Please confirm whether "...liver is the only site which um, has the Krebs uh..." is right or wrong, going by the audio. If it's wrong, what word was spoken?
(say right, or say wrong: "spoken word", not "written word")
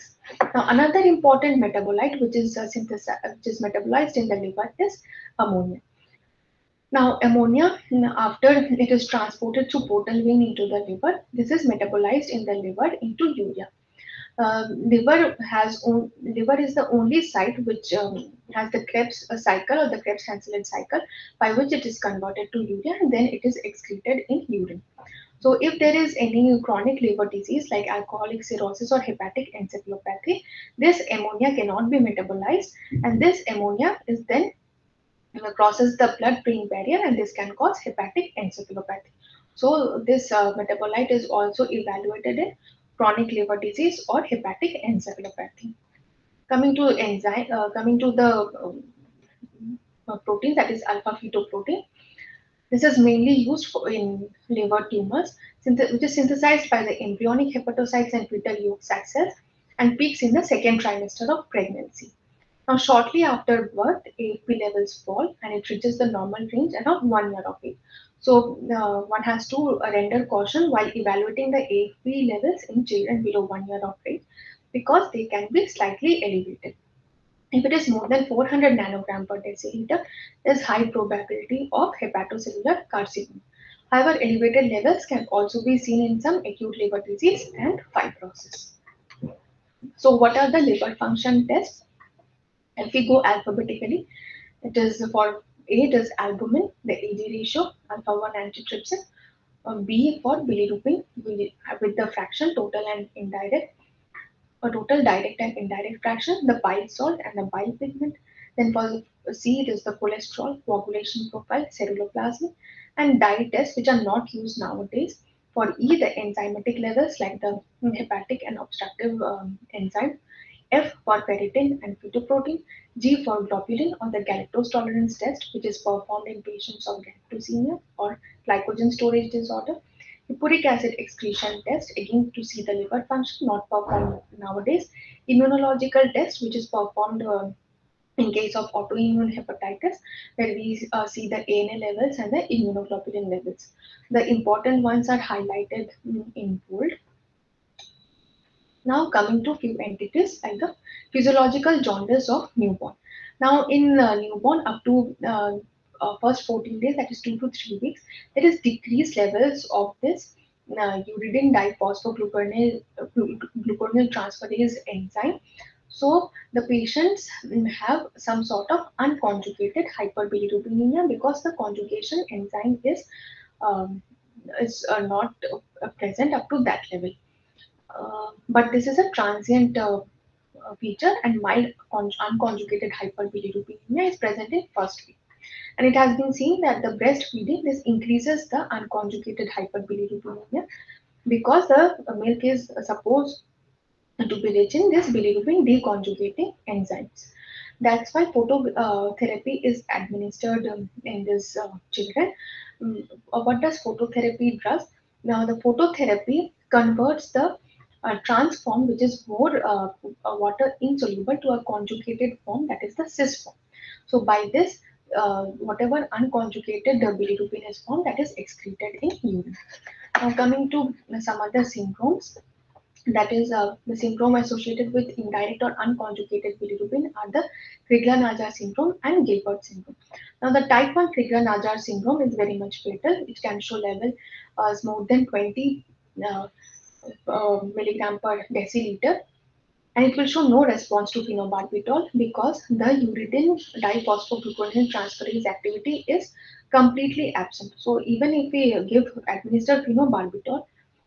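right.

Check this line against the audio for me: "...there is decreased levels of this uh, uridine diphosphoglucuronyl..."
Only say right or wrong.
right.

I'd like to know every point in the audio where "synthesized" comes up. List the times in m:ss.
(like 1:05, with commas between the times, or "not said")
0:56.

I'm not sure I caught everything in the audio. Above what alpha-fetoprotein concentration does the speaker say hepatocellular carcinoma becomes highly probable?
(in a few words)
400 nanogram per deciliter.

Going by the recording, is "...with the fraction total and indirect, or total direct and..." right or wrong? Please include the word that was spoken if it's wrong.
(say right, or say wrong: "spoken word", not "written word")
right.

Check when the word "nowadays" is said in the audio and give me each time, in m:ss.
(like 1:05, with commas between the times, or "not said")
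1:54, 2:14.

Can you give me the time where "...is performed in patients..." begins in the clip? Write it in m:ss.
2:05.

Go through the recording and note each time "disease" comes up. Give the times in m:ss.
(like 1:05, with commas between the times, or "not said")
0:27, 0:43, 1:27.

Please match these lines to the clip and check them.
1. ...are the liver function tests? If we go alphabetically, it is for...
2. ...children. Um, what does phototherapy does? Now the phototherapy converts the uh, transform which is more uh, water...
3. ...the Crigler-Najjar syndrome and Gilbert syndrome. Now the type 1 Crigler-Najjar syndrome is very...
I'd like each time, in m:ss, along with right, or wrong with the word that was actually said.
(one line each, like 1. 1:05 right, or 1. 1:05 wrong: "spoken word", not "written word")
1. 1:30 right
2. 3:21 right
3. 3:47 right.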